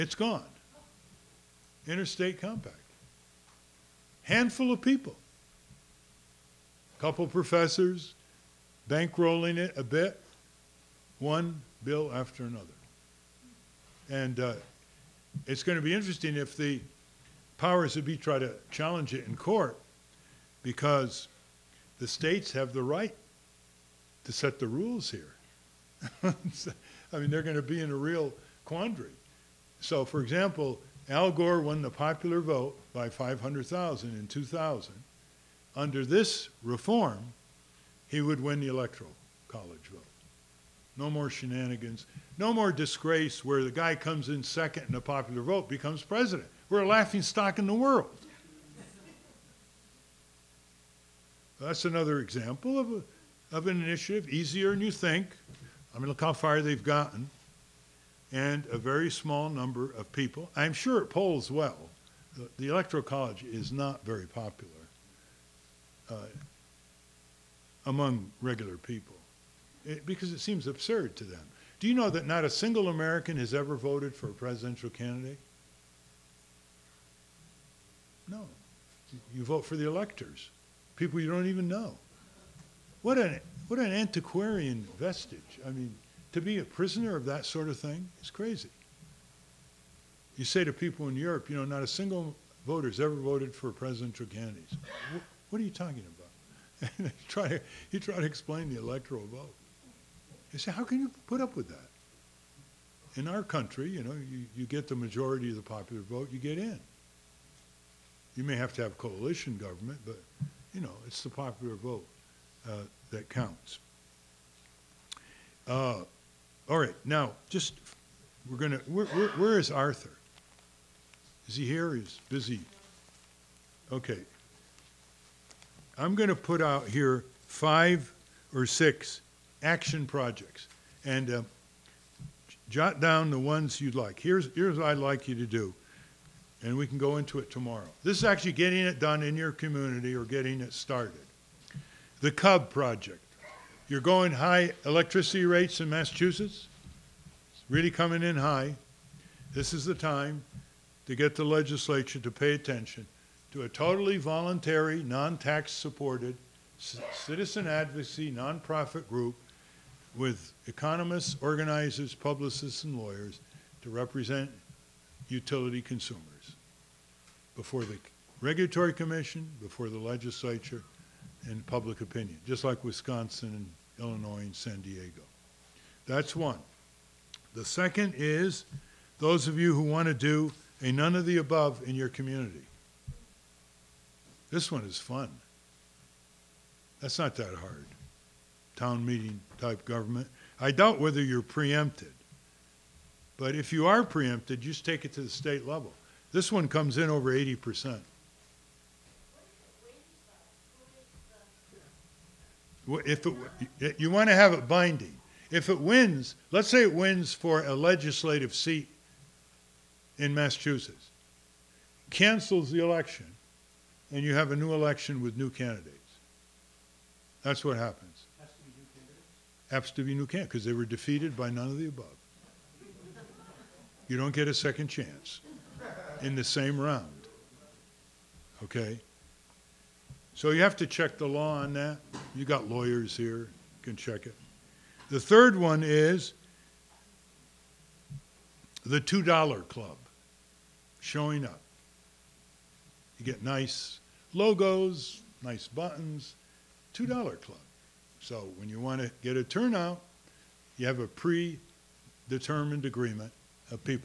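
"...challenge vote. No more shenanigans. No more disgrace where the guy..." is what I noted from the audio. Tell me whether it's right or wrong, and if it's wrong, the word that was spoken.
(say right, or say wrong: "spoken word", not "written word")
wrong: "college", not "challenge".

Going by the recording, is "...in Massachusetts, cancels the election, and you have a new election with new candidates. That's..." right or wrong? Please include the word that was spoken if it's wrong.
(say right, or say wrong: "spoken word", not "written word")
right.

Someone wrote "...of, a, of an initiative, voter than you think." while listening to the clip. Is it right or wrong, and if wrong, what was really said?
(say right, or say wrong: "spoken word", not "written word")
wrong: "easier", not "voter".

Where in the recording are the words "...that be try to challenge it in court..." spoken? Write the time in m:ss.
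0:17.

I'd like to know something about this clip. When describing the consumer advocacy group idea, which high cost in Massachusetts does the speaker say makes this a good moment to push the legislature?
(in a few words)
Electricity rates.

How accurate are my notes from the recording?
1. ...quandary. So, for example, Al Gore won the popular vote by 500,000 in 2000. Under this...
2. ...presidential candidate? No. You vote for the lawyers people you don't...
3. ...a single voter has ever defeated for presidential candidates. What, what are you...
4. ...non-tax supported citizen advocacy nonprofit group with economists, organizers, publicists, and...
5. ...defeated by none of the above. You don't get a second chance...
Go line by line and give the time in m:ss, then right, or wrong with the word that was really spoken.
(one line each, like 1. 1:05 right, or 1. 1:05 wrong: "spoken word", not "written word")
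1. 0:28 right
2. 1:14 wrong: "electors", not "lawyers"
3. 1:31 wrong: "voted", not "defeated"
4. 2:35 right
5. 3:40 right.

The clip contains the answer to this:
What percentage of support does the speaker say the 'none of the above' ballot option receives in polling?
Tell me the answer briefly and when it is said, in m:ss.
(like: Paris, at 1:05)
Over 80%, at 3:17.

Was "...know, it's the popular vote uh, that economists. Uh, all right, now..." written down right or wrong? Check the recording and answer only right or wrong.
wrong.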